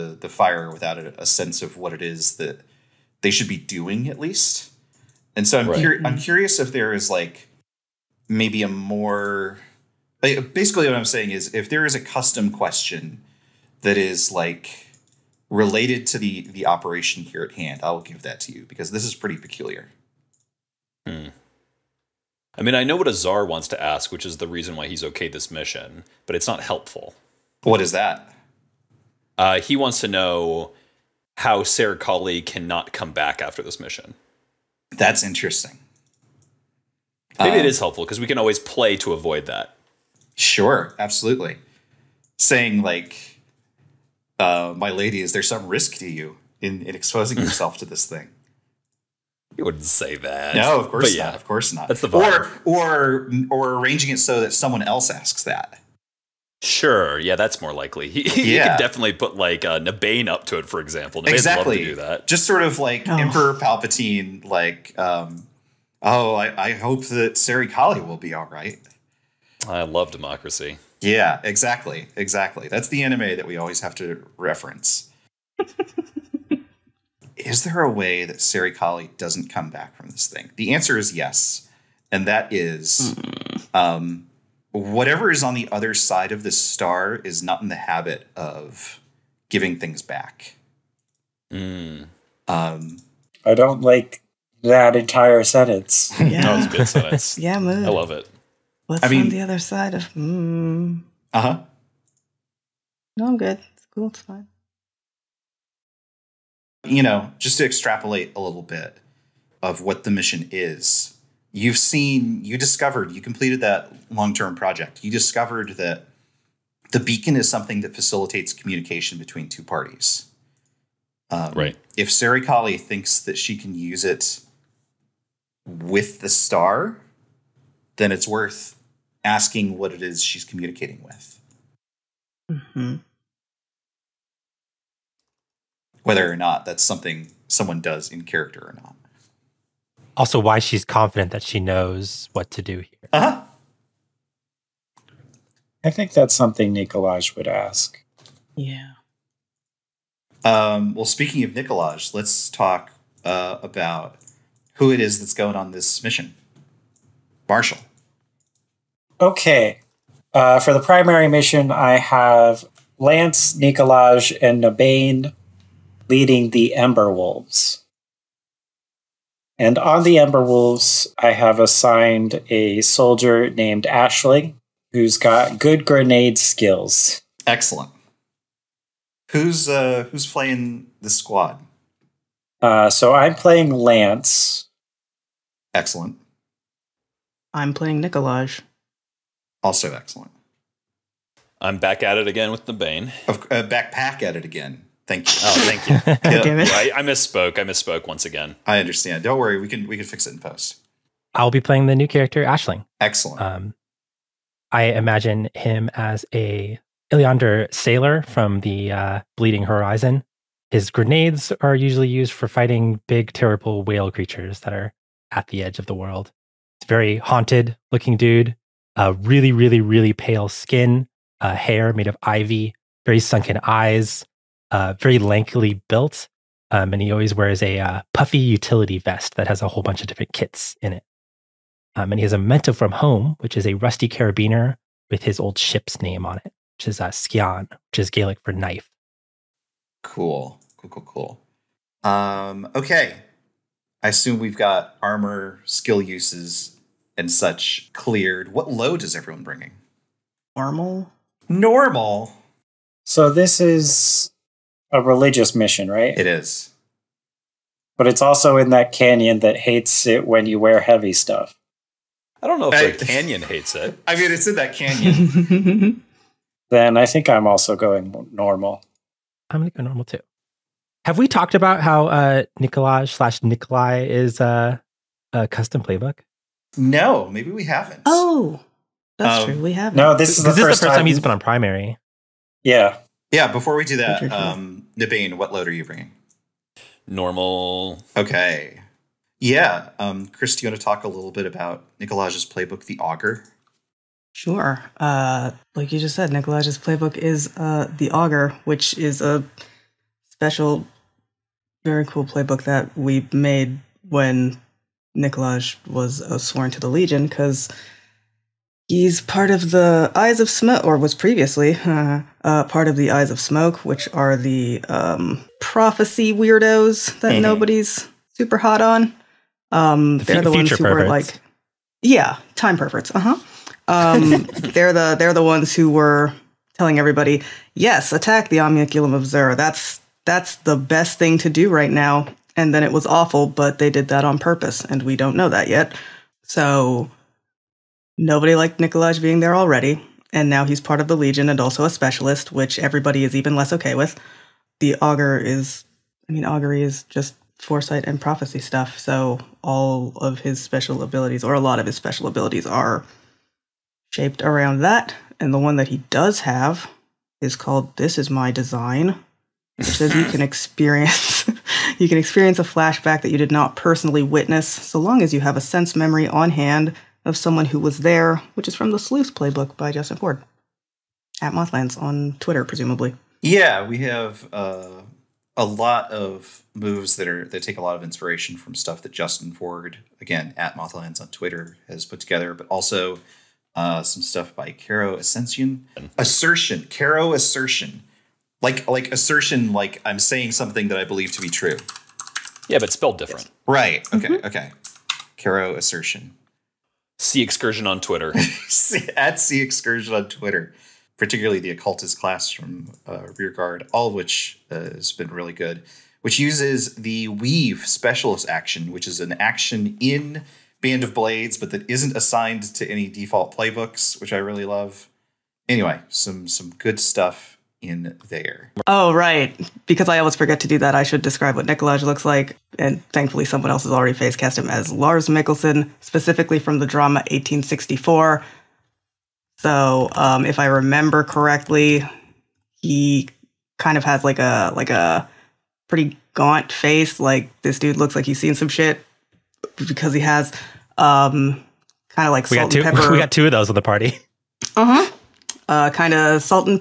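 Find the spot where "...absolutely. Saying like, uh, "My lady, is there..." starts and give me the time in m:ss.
0:40.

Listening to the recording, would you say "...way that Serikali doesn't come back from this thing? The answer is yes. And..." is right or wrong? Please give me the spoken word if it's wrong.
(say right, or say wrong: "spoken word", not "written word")
right.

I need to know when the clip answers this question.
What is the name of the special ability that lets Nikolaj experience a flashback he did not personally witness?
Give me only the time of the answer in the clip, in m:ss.
5:57.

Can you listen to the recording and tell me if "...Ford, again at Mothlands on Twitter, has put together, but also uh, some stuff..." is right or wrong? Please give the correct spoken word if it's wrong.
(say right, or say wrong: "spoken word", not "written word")
right.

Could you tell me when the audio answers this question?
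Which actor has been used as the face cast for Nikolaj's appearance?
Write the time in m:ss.
7:04.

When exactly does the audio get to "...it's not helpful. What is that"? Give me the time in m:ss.
0:26.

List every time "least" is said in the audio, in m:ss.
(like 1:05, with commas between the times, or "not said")
0:04.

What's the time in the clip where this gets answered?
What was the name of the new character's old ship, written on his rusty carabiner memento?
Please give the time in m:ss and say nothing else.
3:57.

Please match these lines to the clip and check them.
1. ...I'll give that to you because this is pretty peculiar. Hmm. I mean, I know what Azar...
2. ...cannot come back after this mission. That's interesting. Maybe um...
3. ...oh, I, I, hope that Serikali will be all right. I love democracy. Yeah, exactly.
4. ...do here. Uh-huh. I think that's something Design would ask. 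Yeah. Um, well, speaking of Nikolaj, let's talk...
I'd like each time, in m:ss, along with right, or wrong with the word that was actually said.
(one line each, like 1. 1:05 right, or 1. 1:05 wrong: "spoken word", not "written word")
1. 0:17 right
2. 0:32 right
3. 1:06 right
4. 2:22 wrong: "Nikolaj", not "Design".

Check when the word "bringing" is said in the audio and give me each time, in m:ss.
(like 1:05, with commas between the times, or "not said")
4:09, 4:45.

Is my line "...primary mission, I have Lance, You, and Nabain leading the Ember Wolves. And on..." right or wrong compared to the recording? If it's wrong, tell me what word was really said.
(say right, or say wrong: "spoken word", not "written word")
wrong: "Nikolaj", not "You".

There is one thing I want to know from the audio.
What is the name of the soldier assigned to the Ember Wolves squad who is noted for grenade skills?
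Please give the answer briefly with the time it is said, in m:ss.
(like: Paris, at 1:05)
Ashley, at 2:53.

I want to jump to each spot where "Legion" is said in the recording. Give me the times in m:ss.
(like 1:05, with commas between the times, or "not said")
5:06, 5:41.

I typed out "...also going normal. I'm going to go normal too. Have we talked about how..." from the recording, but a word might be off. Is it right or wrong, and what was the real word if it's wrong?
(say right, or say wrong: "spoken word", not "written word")
right.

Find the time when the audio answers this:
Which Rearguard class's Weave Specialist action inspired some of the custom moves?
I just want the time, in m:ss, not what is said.
6:41.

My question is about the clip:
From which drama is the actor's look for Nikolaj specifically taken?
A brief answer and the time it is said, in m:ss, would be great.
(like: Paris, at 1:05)
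1864, at 7:07.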